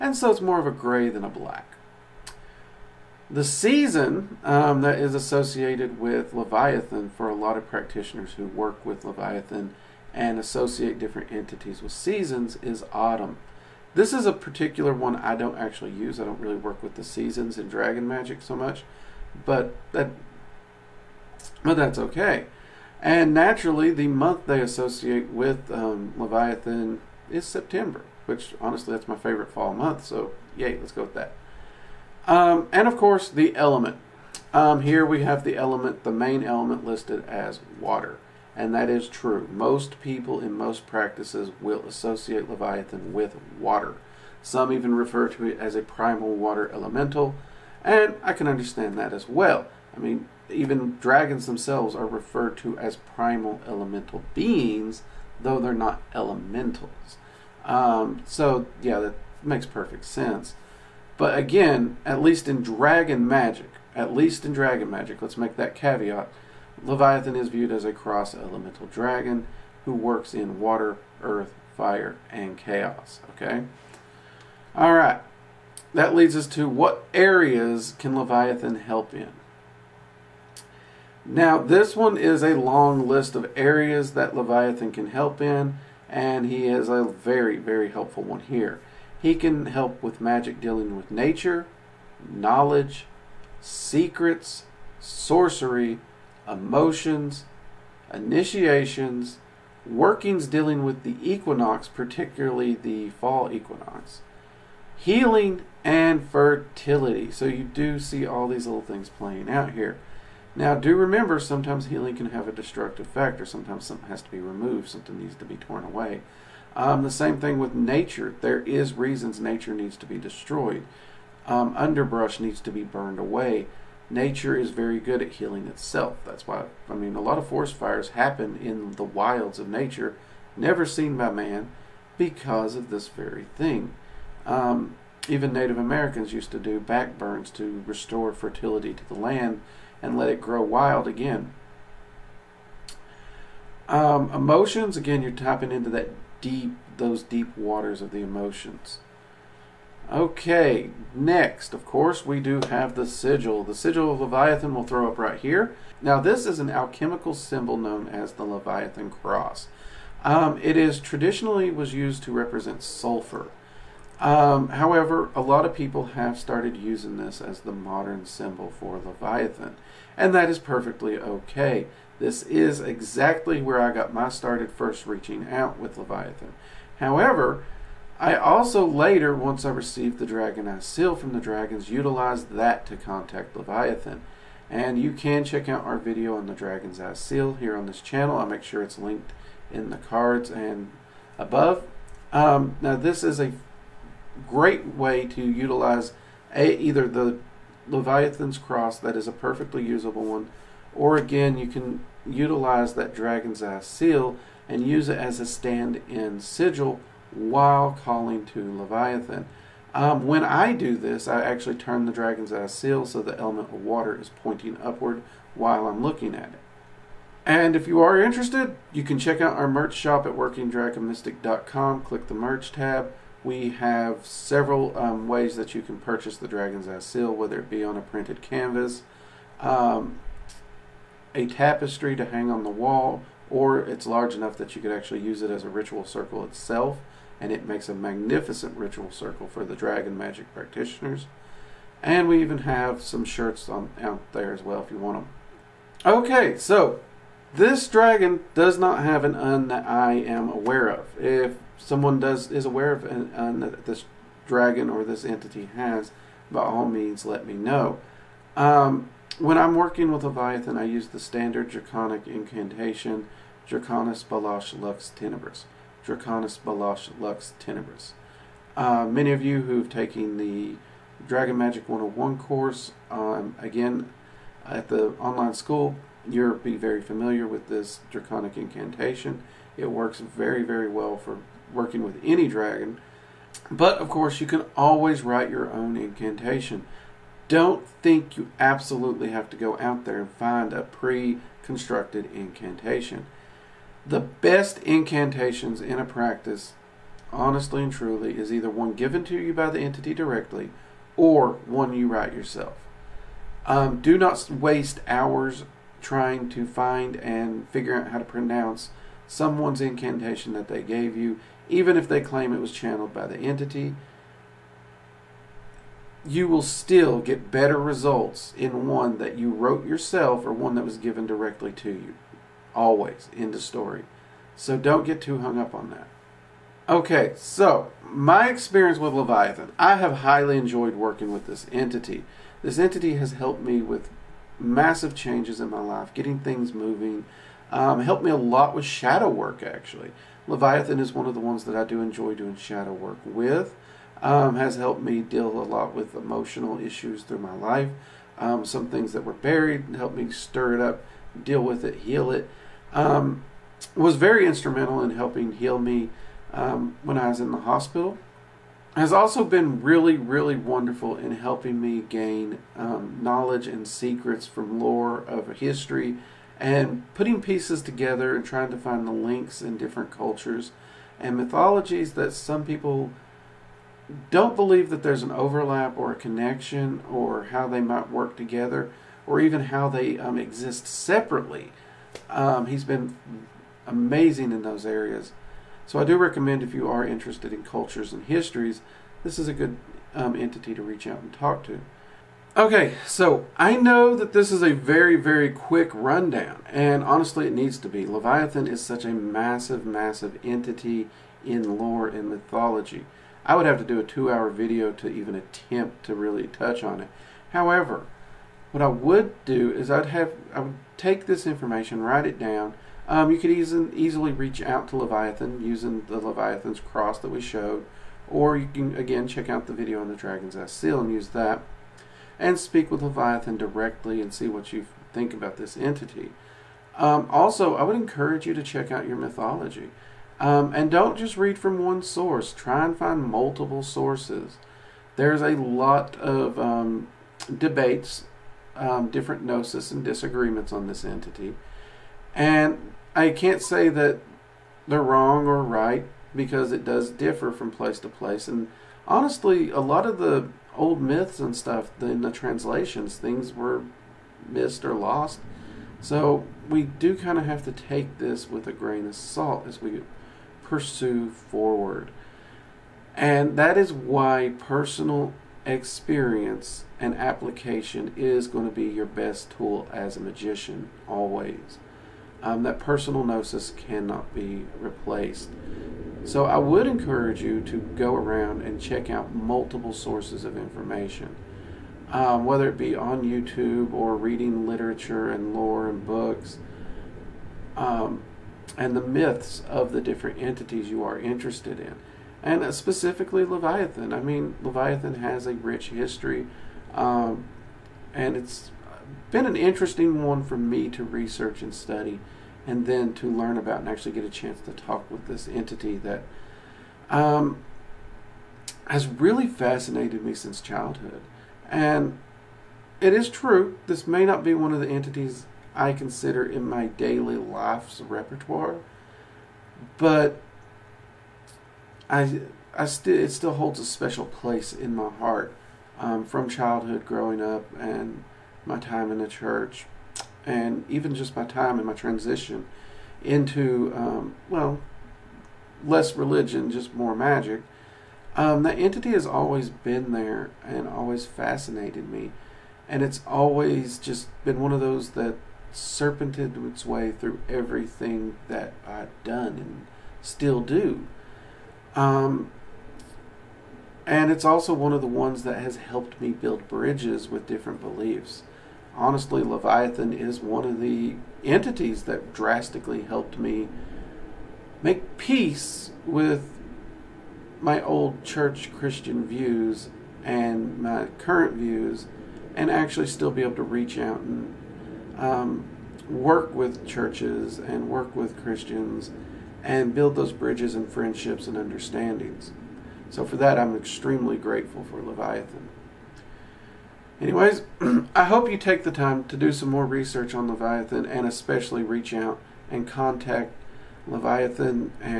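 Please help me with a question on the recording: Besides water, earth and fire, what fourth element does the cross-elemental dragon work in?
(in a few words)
Chaos.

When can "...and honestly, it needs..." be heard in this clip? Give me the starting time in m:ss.
6:36.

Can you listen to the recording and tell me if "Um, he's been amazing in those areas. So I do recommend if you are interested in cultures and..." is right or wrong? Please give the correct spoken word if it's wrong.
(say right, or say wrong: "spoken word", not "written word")
right.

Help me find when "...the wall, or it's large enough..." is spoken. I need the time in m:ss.
3:52.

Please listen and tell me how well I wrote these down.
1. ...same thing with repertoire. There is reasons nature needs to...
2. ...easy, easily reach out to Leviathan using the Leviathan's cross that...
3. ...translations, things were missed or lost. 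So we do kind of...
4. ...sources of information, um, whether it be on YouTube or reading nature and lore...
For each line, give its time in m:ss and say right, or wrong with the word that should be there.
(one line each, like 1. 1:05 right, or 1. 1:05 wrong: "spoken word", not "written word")
1. 1:57 wrong: "nature", not "repertoire"
2. 6:53 right
3. 7:32 right
4. 7:59 wrong: "literature", not "nature".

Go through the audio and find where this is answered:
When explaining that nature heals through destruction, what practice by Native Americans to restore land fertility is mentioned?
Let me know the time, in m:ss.
2:16.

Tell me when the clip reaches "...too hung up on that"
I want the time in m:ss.
5:25.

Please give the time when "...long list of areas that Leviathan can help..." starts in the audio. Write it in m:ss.
1:22.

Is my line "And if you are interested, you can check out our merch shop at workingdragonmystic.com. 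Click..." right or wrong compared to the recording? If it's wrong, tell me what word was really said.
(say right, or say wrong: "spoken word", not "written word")
right.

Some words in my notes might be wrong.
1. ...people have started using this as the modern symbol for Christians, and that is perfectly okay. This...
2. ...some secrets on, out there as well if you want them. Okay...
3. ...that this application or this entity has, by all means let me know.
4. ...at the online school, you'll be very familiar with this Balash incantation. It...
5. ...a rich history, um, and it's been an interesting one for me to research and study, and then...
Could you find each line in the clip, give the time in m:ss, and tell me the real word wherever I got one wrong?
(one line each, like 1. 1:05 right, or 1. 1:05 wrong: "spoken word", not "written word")
1. 2:45 wrong: "Leviathan", not "Christians"
2. 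4:03 wrong: "shirts", not "secrets"
3. 4:13 wrong: "dragon", not "application"
4. 4:34 wrong: "Draconic", not "Balash"
5. 8:15 right.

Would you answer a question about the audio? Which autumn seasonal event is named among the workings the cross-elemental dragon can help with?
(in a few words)
Fall equinox.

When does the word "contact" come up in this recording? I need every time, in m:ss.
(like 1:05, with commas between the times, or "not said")
3:02, 9:52.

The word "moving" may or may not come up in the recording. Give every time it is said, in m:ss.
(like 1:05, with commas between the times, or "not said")
5:36.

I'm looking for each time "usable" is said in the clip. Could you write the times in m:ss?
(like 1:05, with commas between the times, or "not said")
3:19.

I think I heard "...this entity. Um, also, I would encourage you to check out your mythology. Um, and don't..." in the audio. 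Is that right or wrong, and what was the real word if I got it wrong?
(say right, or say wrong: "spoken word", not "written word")
right.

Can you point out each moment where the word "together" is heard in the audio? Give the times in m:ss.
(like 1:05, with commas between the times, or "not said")
6:07, 6:18.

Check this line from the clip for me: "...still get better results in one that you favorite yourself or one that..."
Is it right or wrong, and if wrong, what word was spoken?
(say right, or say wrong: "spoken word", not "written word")
wrong: "wrote", not "favorite".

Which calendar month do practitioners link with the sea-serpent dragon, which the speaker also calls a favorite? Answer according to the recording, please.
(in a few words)
September.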